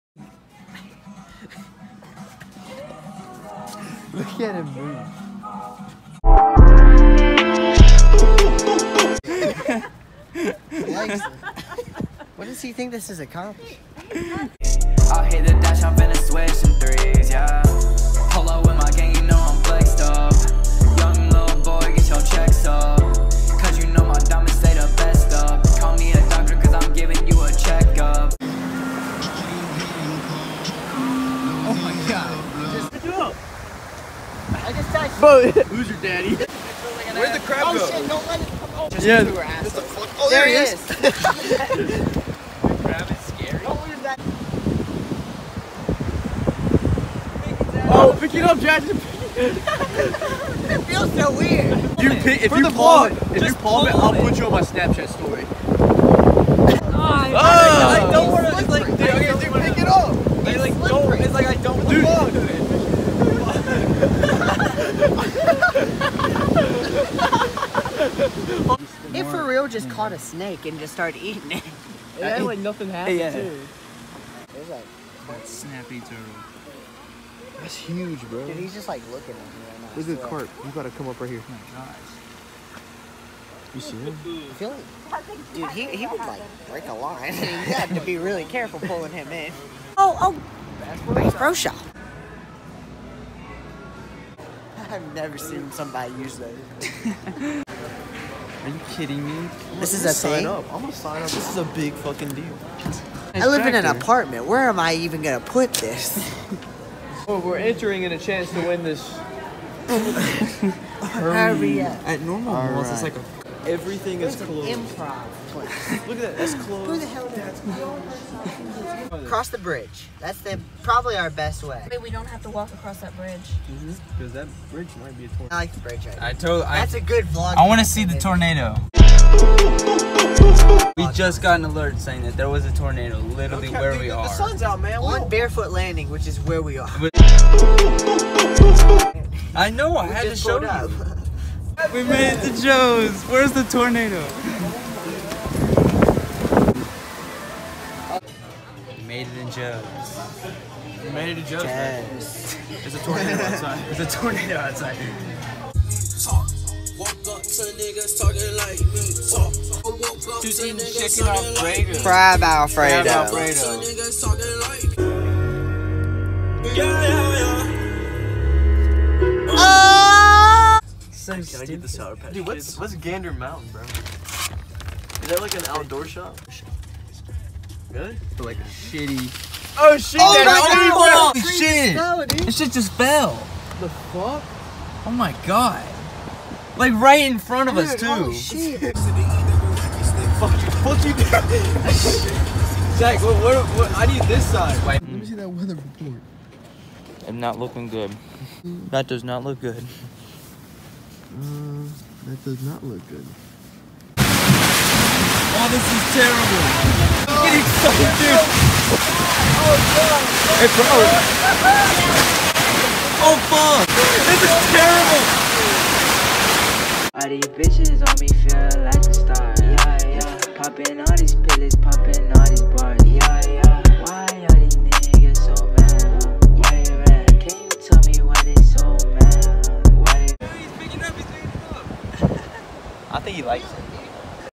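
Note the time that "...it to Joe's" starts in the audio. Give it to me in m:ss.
2:22.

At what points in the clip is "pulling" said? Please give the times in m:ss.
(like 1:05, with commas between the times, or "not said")
1:28.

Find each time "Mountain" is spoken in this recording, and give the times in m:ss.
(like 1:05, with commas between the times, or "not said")
2:53.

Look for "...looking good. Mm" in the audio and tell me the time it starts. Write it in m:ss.
3:17.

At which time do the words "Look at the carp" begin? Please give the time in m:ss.
1:19.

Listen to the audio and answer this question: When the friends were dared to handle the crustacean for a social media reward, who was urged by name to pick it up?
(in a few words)
Jackson.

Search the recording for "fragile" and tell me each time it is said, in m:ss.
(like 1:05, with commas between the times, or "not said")
not said.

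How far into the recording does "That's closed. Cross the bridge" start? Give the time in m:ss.
1:57.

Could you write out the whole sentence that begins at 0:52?
You pick, if For you palm it, if you palm it, I'll put you on my Snapchat story.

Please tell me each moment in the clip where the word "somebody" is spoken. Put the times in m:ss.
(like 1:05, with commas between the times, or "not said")
1:35.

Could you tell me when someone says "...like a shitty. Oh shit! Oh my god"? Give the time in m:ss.
2:58.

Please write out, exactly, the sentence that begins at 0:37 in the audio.
Shit, don't let it come oh.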